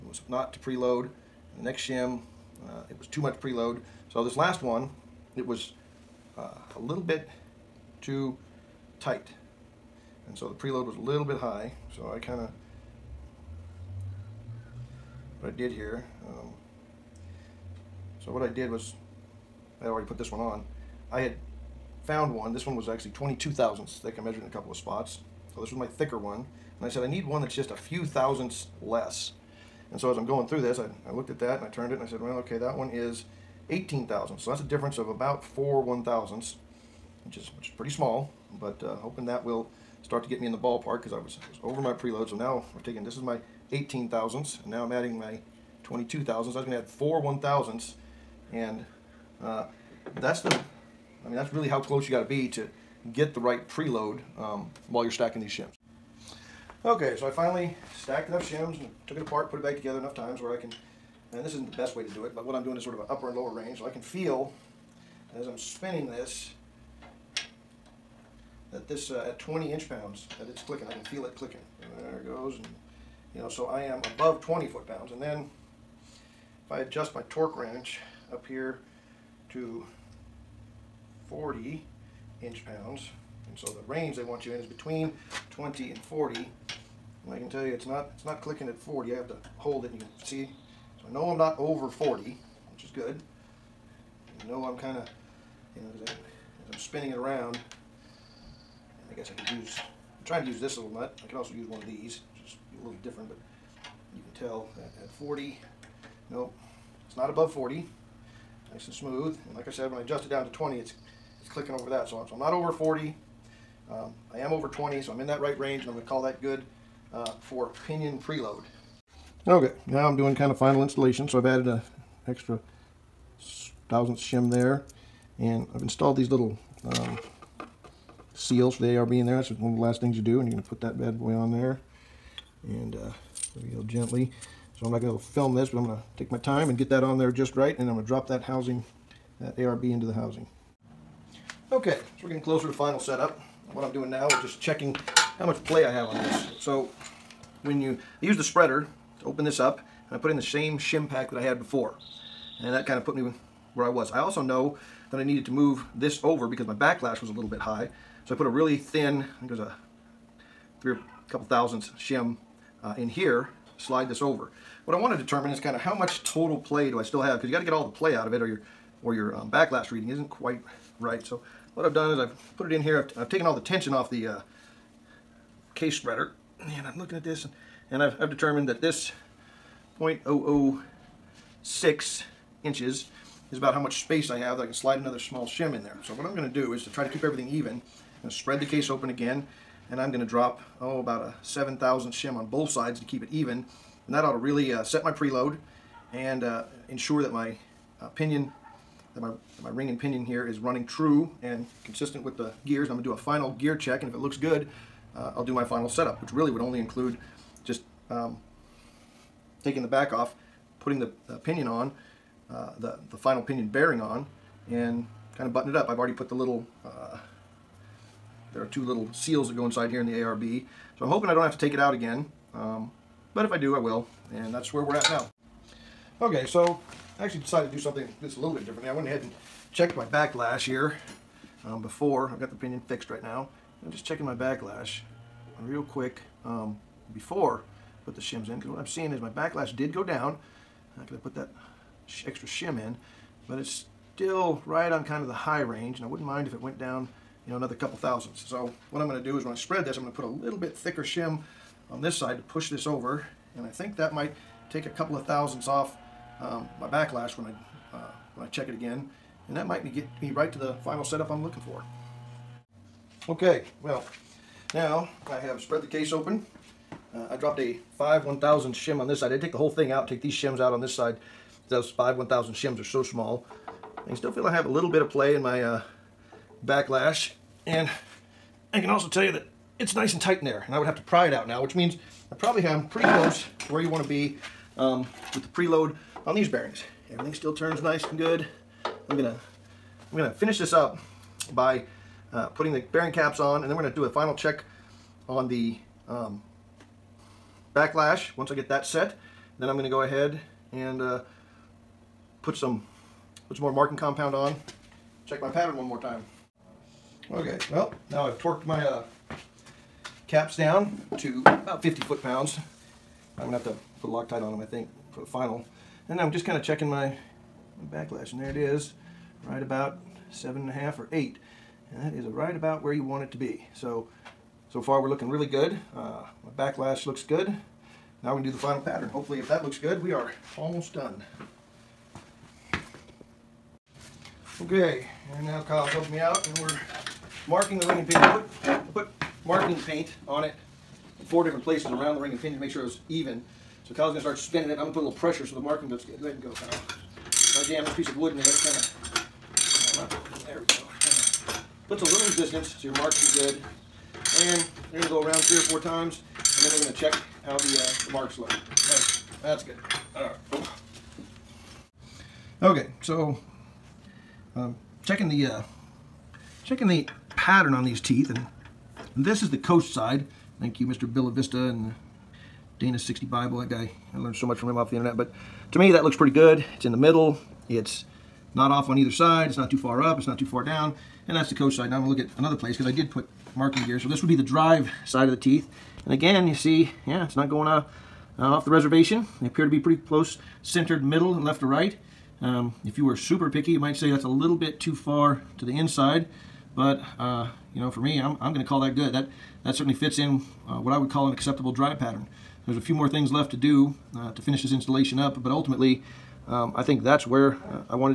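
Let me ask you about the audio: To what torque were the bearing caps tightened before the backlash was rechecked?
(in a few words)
50 foot-pounds.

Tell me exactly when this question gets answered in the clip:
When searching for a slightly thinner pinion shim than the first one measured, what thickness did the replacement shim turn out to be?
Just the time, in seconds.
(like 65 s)
32 s.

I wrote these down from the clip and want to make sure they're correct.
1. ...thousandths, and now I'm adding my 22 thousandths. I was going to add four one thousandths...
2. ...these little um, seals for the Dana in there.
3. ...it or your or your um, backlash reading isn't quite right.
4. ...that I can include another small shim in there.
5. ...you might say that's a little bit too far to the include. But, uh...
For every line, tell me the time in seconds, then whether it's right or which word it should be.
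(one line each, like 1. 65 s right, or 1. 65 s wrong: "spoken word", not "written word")
1. 44 s right
2. 126 s wrong: "ARB", not "Dana"
3. 168 s right
4. 184 s wrong: "slide", not "include"
5. 393 s wrong: "inside", not "include".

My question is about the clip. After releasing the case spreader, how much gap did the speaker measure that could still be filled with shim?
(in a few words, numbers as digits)
0.006 inches.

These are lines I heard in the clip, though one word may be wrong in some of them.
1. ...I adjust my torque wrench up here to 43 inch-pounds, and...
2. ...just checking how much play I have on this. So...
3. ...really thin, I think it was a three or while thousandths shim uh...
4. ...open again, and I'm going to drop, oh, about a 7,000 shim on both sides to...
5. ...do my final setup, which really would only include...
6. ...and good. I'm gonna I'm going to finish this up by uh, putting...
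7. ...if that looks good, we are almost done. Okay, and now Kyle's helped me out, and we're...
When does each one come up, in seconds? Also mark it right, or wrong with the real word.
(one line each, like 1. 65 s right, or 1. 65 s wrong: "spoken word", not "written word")
1. 76 s wrong: "40", not "43"
2. 144 s right
3. 158 s wrong: "couple", not "while"
4. 188 s right
5. 205 s right
6. 288 s right
7. 329 s right.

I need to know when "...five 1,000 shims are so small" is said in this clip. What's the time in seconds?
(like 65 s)
271 s.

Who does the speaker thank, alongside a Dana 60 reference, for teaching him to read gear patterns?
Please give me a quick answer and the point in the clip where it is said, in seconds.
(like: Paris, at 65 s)
Mr. BillaVista, at 370 s.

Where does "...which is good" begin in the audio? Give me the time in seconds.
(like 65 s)
92 s.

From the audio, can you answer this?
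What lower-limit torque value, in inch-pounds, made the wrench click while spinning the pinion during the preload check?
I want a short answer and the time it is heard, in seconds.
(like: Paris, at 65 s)
20 inch-pounds, at 69 s.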